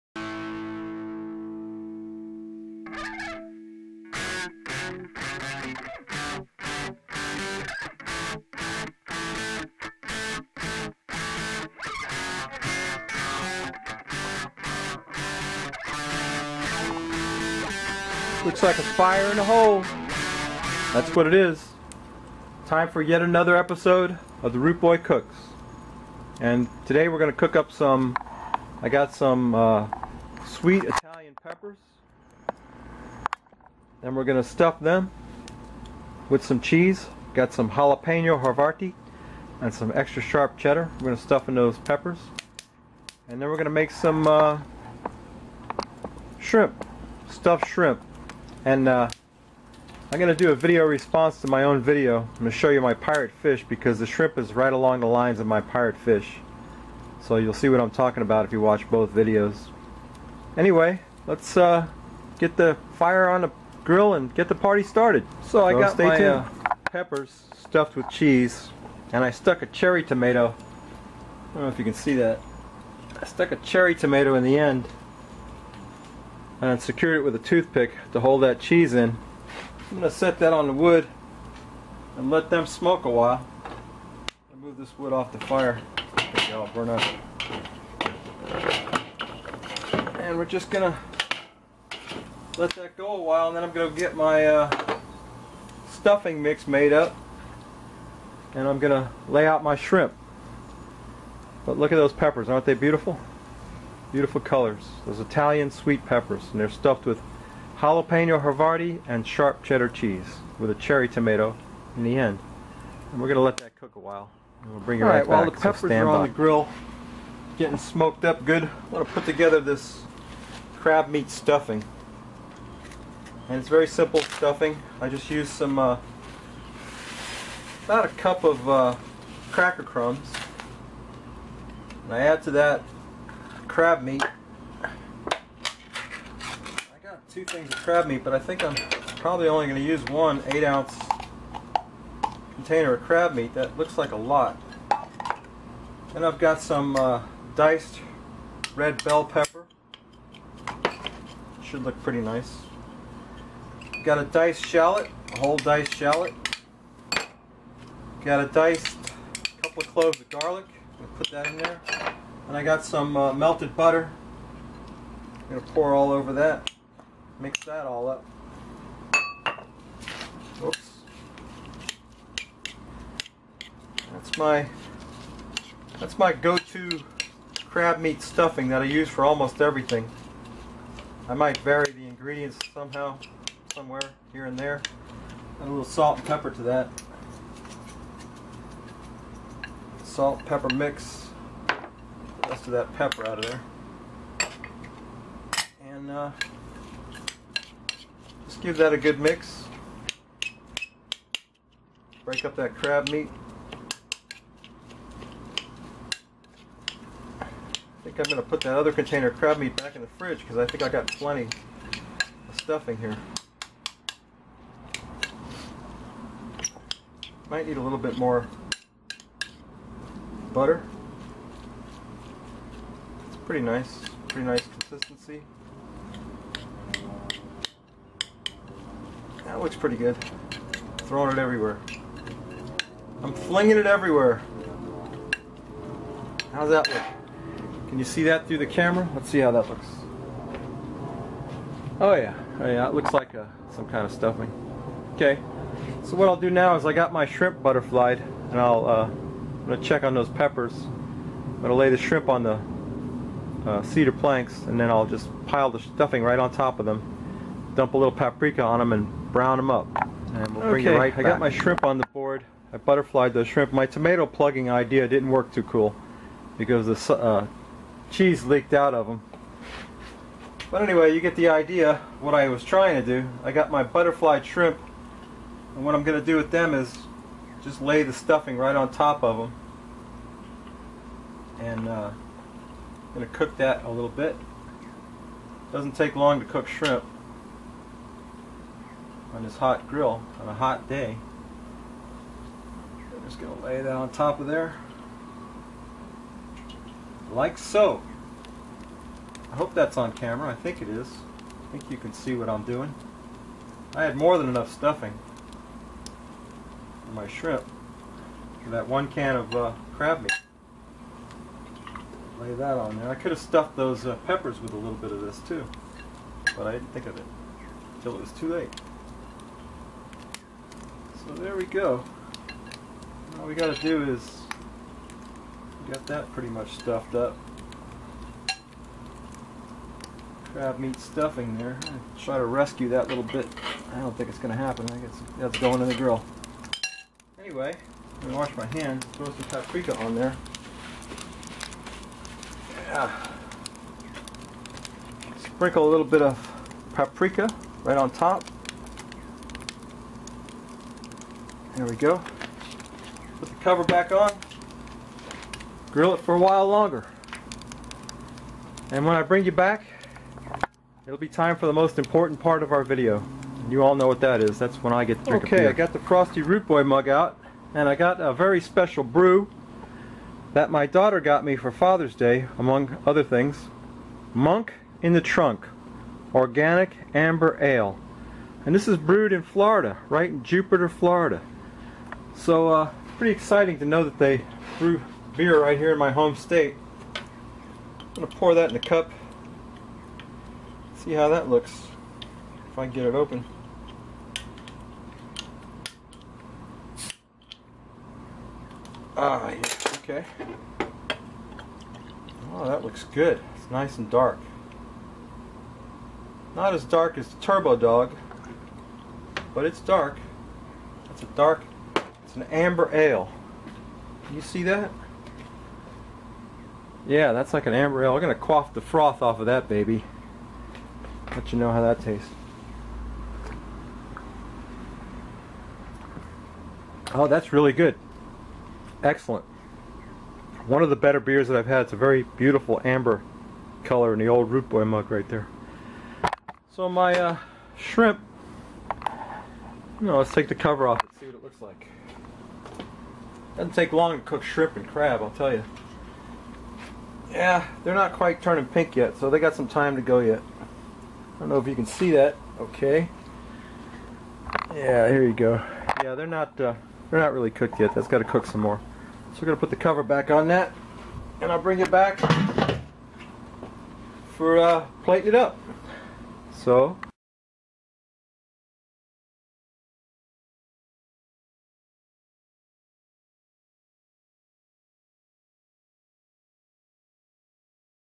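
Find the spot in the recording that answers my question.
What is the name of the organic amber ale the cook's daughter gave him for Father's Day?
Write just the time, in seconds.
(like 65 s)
374 s.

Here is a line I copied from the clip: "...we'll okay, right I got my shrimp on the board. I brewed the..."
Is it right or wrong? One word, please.
wrong.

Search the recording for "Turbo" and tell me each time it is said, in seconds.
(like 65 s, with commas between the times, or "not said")
407 s.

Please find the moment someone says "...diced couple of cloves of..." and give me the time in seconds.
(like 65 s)
158 s.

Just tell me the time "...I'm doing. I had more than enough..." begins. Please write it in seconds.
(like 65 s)
302 s.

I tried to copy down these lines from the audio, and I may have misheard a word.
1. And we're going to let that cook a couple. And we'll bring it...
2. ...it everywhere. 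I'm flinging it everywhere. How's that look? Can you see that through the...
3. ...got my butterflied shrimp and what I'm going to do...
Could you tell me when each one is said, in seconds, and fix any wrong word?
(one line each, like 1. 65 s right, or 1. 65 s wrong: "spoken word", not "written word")
1. 113 s wrong: "while", not "couple"
2. 231 s right
3. 273 s right.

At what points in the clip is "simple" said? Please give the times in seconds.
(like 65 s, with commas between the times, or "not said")
123 s.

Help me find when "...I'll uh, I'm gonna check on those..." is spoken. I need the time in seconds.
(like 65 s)
248 s.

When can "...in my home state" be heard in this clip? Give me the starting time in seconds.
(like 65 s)
385 s.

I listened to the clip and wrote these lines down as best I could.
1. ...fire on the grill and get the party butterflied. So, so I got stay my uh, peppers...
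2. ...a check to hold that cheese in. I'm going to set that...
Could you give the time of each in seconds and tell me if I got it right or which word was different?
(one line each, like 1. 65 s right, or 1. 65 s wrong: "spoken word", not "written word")
1. 62 s wrong: "started", not "butterflied"
2. 77 s wrong: "toothpick", not "check".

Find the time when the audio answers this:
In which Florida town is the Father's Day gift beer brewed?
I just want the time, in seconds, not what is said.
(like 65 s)
380 s.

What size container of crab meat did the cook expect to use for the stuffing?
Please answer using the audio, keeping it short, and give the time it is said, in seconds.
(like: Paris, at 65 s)
8 ounce, at 140 s.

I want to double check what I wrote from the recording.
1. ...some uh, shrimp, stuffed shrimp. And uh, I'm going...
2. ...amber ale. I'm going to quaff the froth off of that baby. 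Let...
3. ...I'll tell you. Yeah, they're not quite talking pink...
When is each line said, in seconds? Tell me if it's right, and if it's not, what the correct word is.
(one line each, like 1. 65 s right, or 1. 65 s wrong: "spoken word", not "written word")
1. 43 s right
2. 417 s right
3. 445 s wrong: "turning", not "talking".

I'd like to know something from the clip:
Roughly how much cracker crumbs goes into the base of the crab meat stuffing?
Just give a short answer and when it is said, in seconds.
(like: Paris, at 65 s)
About a cup, at 127 s.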